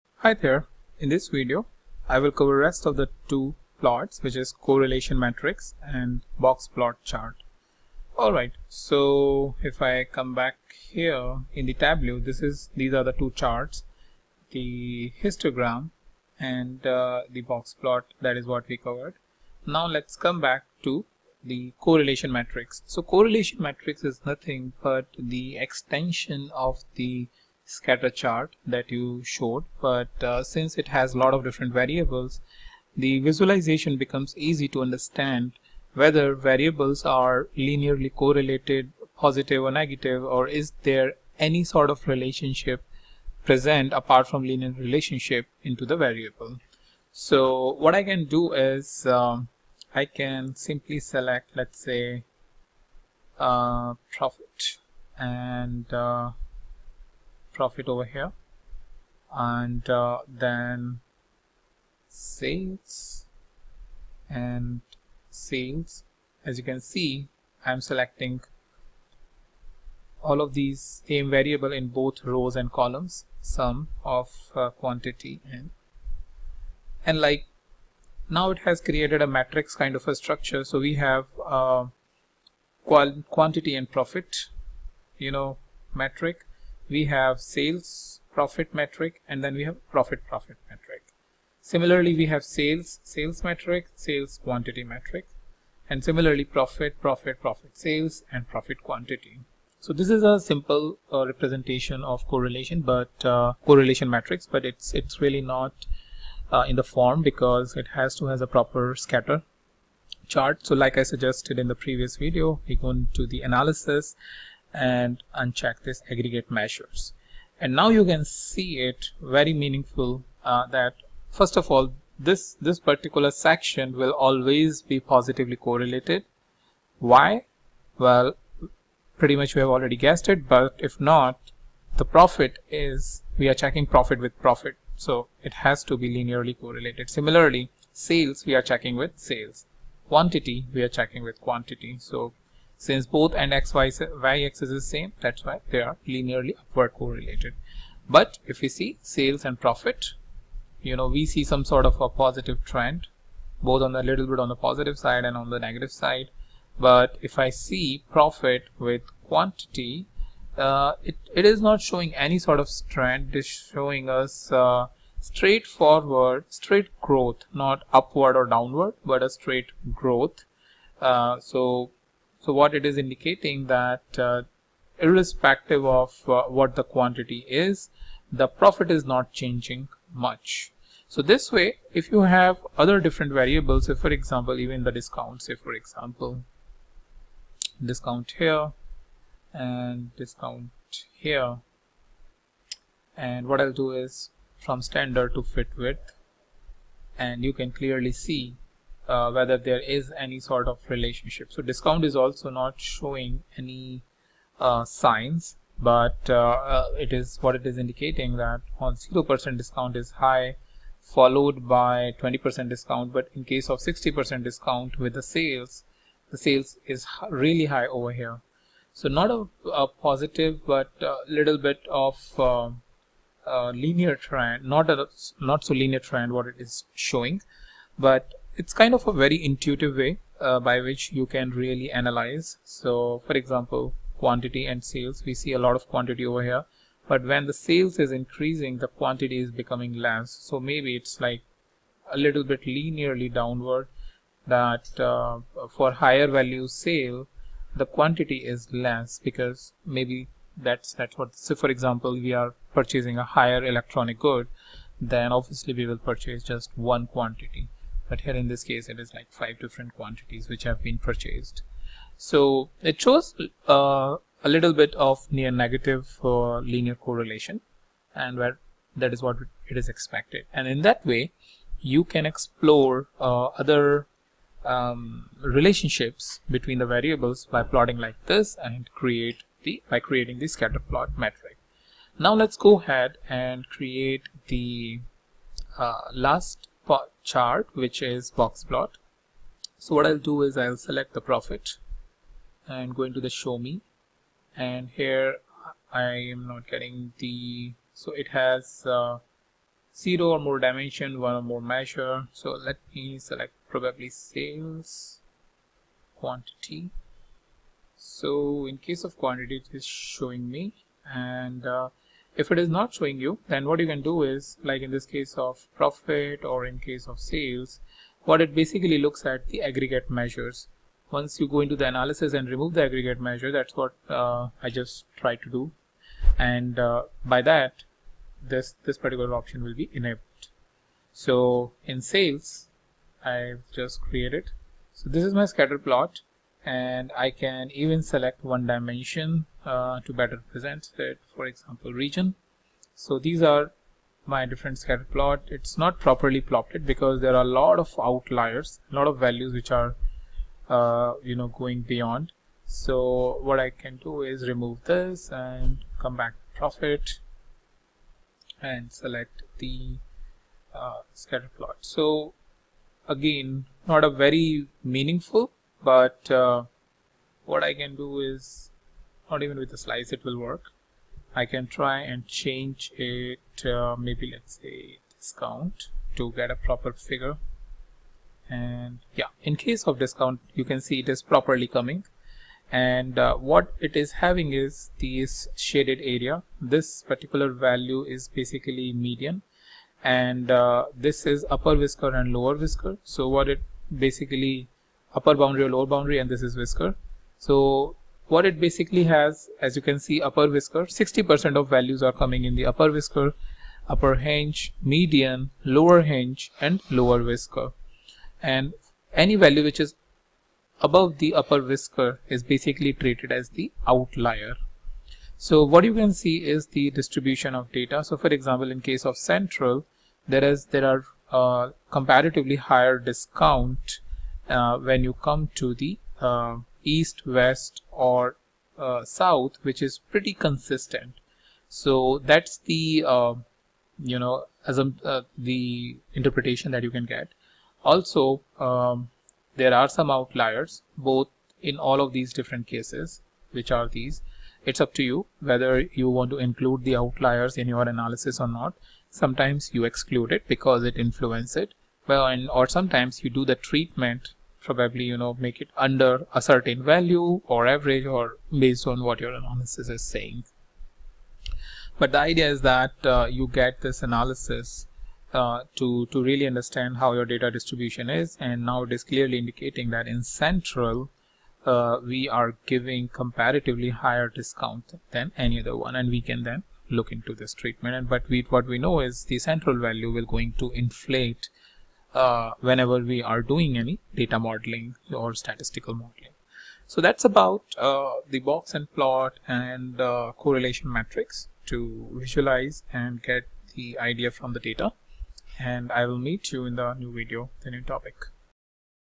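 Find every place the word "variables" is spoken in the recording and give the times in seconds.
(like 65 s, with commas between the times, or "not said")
31 s, 36 s, 45 s, 71 s, 183 s, 276 s.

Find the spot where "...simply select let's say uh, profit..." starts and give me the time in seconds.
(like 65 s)
50 s.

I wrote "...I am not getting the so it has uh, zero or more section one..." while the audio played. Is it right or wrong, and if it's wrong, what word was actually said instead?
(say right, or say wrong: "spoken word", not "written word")
wrong: "dimension", not "section".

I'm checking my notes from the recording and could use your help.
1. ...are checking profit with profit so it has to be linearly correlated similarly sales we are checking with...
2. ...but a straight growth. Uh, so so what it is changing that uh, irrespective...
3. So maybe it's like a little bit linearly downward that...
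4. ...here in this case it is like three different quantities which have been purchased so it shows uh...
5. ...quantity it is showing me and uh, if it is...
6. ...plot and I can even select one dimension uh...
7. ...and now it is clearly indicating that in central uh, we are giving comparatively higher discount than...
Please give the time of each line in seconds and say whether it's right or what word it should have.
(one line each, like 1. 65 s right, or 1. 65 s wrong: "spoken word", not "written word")
1. 133 s right
2. 169 s wrong: "indicating", not "changing"
3. 240 s right
4. 258 s wrong: "five", not "three"
5. 309 s right
6. 335 s right
7. 468 s right.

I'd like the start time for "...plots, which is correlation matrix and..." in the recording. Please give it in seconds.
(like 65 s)
3 s.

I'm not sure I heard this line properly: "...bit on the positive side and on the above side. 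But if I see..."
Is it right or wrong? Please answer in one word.
wrong.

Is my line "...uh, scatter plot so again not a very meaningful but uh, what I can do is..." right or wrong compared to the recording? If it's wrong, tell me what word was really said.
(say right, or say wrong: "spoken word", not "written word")
right.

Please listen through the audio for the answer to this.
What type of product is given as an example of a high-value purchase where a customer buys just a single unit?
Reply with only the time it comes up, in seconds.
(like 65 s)
253 s.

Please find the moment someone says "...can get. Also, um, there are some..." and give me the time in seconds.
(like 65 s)
436 s.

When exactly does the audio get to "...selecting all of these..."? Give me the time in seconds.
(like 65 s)
67 s.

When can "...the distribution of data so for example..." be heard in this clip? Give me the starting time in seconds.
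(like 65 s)
416 s.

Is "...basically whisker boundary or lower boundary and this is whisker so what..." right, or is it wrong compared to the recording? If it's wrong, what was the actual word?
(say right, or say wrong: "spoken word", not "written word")
wrong: "upper", not "whisker".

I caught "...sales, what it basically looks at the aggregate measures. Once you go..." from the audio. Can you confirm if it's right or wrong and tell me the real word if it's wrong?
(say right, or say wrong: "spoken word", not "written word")
right.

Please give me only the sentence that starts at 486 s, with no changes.
So that's about uh, the box and plot and uh, correlation matrix to visualize and get the idea from the data.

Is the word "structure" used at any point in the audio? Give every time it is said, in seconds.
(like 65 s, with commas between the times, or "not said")
80 s.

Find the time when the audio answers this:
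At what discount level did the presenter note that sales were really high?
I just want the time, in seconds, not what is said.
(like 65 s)
213 s.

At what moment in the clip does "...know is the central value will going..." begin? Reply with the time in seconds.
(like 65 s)
478 s.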